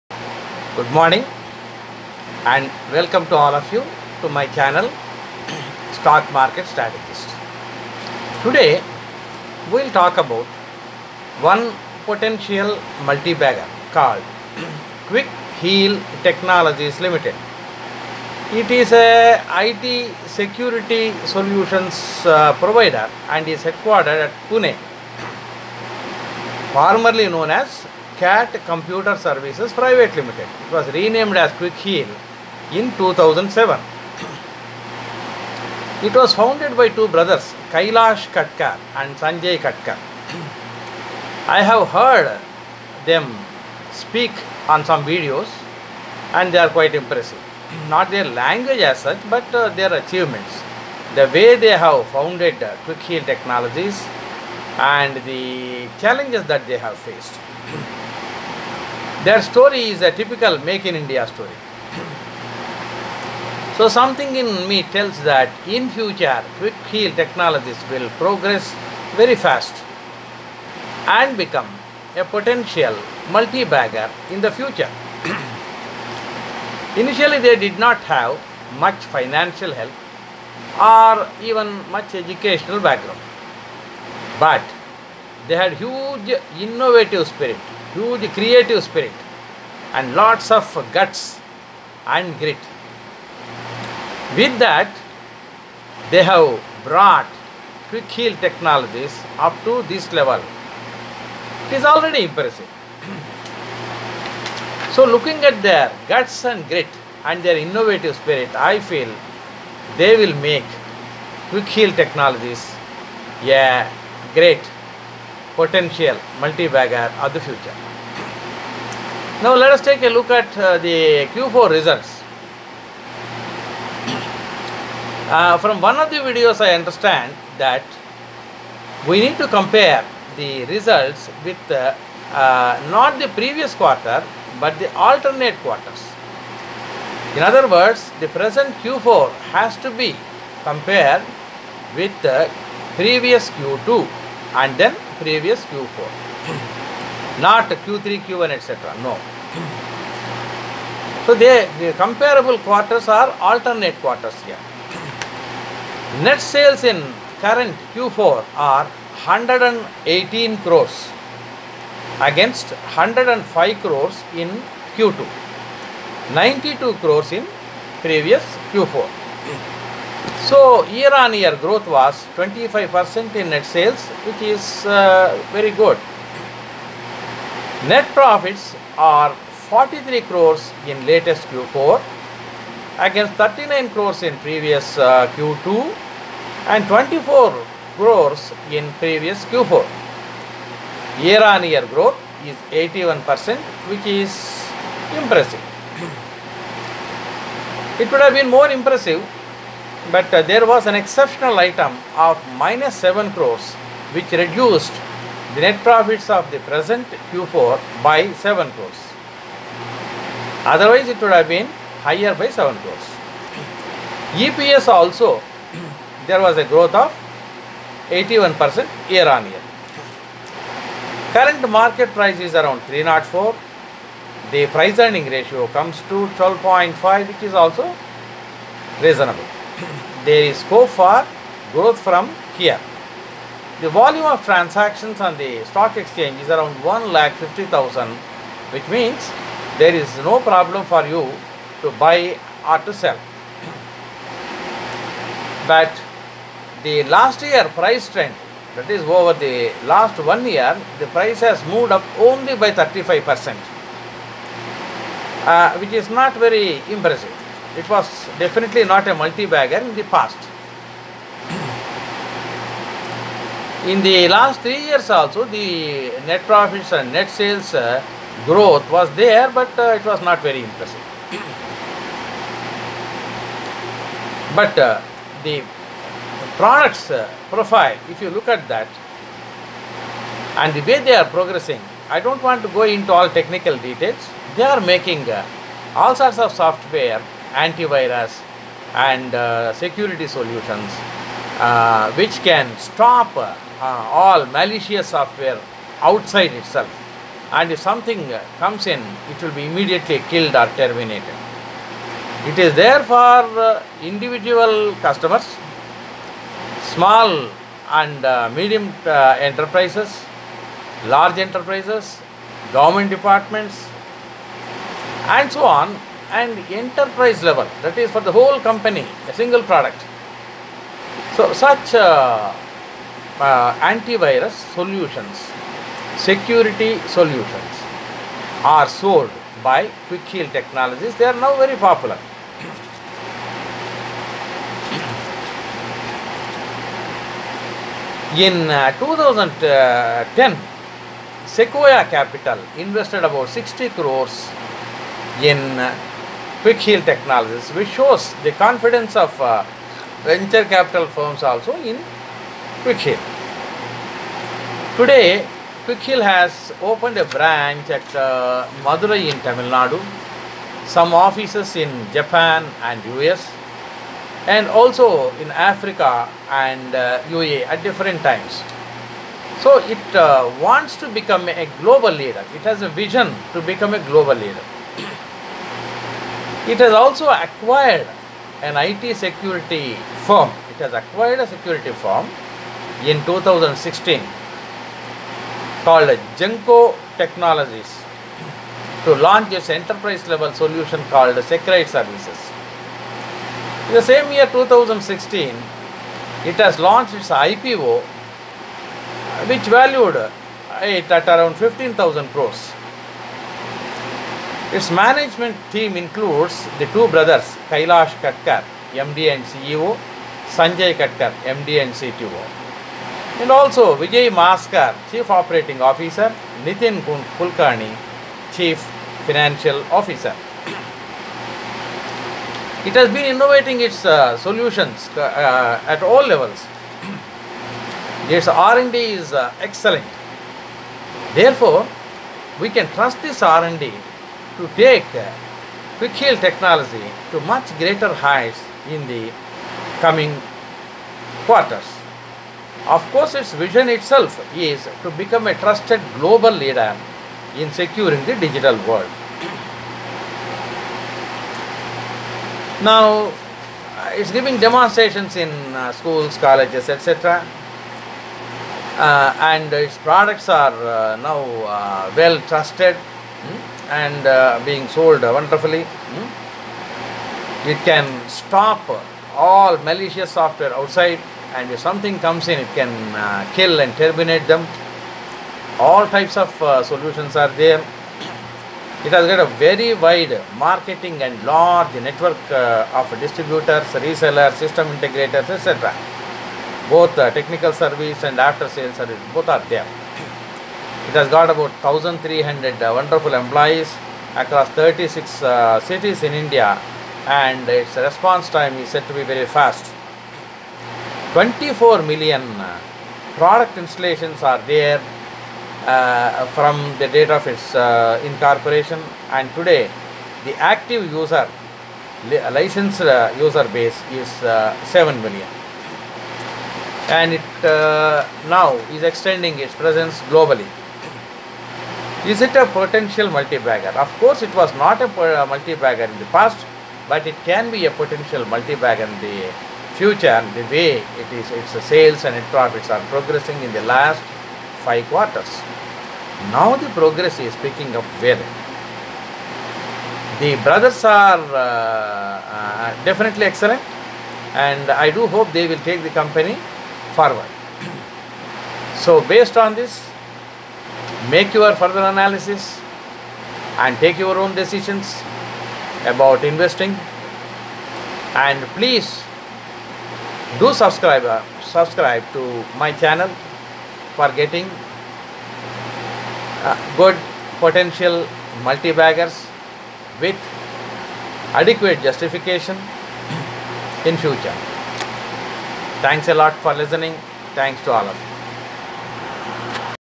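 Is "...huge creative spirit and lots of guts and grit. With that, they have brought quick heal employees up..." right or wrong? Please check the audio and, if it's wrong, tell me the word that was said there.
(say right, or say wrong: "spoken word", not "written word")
wrong: "technologies", not "employees".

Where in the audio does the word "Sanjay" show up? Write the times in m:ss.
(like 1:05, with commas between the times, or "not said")
0:39, 6:50.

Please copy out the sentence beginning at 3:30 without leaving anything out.
Otherwise, it would have been higher by 7 crores.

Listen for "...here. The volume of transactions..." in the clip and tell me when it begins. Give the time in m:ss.
3:52.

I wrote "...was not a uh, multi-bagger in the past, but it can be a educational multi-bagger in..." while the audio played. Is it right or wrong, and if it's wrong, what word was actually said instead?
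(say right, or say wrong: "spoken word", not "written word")
wrong: "potential", not "educational".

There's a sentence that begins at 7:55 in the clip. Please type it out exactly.
All types of uh, solutions are there.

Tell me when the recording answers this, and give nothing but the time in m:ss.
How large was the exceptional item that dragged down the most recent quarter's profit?
3:22.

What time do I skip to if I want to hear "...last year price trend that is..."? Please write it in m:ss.
4:07.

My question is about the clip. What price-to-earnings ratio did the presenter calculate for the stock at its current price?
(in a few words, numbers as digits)
12.5.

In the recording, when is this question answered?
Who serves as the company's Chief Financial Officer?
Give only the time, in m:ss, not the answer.
6:56.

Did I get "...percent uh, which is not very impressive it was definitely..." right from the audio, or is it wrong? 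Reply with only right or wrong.
right.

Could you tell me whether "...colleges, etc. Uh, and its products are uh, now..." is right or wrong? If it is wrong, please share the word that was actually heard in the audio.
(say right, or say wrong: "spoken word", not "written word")
right.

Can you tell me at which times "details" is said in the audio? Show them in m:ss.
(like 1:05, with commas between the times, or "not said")
4:43.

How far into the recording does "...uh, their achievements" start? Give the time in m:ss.
0:49.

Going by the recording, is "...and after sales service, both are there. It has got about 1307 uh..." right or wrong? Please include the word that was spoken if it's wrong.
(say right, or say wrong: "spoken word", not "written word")
wrong: "1300", not "1307".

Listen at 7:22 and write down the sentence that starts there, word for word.
Of course, its vision itself is to become a trusted global leader in securing the digital world.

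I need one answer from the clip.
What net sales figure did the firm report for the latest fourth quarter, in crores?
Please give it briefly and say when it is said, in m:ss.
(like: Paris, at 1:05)
118 crores, at 2:39.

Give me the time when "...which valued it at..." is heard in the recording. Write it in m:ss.
6:39.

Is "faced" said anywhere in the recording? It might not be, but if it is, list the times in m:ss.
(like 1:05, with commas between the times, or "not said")
0:56.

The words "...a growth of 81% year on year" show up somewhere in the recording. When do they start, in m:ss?
3:36.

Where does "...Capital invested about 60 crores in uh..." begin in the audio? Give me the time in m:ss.
5:42.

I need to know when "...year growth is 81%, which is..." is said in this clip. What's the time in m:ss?
3:11.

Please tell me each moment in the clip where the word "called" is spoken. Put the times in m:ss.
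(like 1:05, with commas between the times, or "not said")
0:13, 6:25, 6:31.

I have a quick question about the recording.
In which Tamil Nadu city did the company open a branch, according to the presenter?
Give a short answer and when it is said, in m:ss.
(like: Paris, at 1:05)
Madurai, at 5:58.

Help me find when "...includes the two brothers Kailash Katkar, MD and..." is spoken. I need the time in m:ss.
6:45.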